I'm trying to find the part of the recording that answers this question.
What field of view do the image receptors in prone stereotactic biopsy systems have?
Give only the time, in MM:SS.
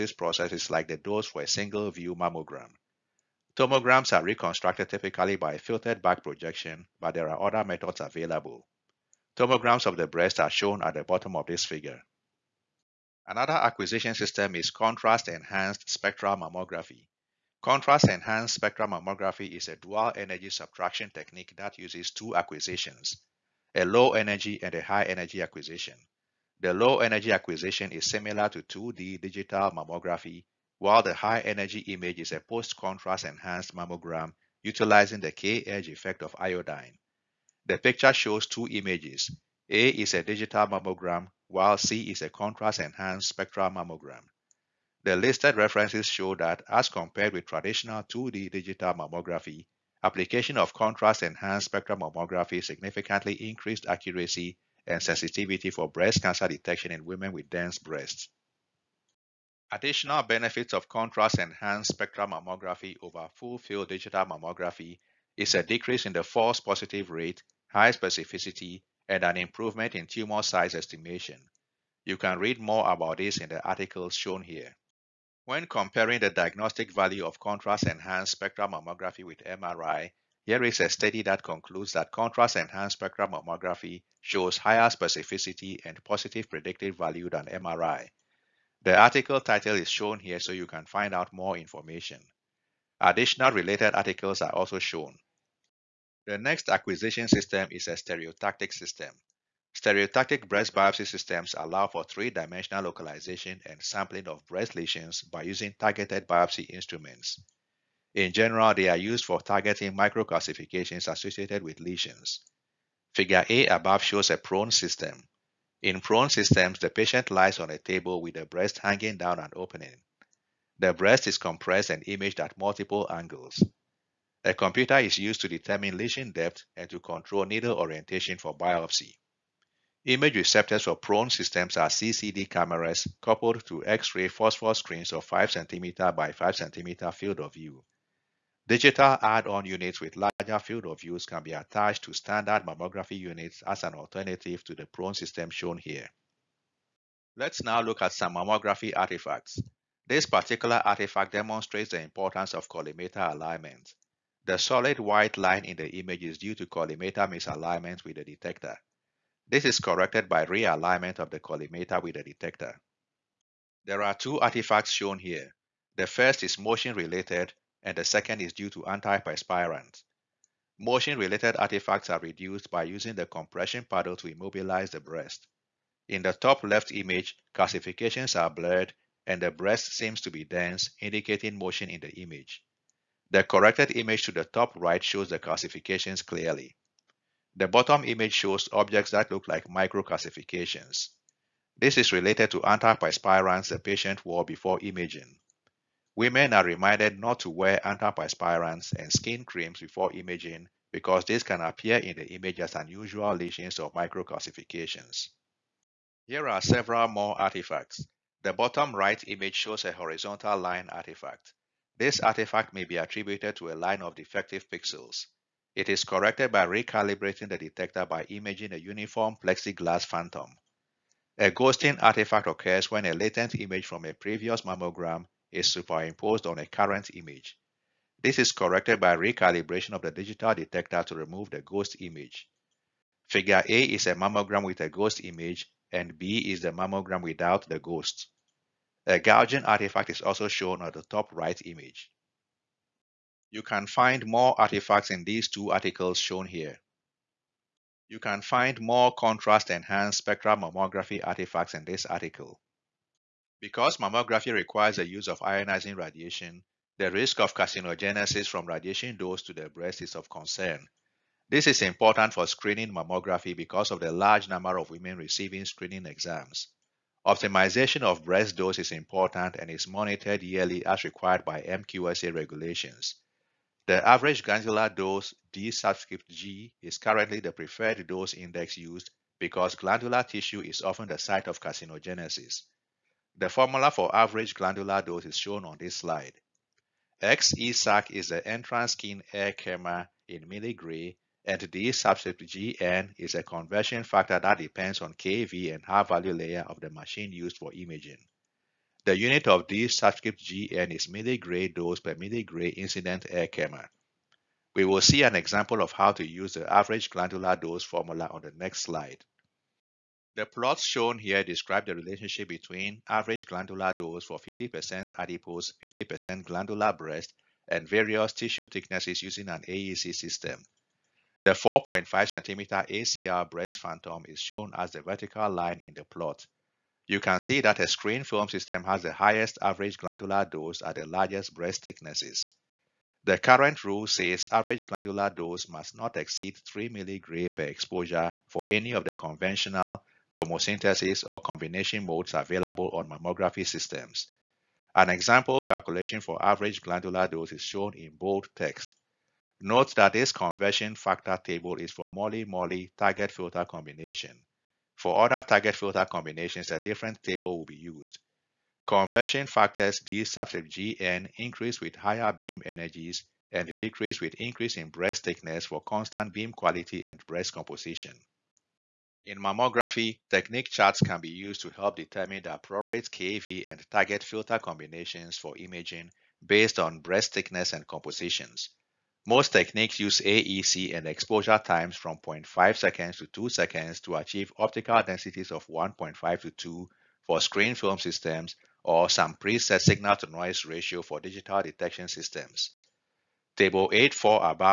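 02:15.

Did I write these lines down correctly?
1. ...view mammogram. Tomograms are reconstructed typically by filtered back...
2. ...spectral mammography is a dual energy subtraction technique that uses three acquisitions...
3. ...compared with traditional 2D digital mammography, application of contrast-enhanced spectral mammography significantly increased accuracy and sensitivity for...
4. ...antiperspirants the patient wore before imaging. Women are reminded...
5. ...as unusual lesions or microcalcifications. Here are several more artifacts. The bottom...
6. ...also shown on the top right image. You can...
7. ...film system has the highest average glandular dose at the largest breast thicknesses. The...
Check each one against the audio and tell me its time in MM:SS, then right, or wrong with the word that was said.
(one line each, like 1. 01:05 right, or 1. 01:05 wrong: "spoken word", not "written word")
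1. 00:01 right
2. 00:18 wrong: "two", not "three"
3. 00:46 right
4. 03:12 right
5. 03:22 right
6. 04:00 right
7. 05:28 right.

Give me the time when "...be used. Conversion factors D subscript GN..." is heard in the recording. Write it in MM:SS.
05:57.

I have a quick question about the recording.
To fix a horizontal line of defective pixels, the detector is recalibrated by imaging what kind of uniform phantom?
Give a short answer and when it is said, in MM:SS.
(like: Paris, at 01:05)
plexiglass phantom, at 03:38.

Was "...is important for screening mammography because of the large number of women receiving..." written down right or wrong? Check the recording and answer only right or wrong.
right.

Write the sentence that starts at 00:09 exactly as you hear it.
Tomograms of the breast are shown at the bottom of this figure.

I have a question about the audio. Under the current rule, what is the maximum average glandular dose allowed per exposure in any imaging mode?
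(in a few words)
3 milligray.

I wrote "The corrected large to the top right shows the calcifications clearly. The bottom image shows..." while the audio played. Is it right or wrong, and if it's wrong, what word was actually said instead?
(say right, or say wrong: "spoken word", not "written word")
wrong: "image", not "large".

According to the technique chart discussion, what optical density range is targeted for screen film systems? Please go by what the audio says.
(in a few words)
1.5 to 2.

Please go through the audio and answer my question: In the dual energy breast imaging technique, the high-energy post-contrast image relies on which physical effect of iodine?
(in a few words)
K-edge effect.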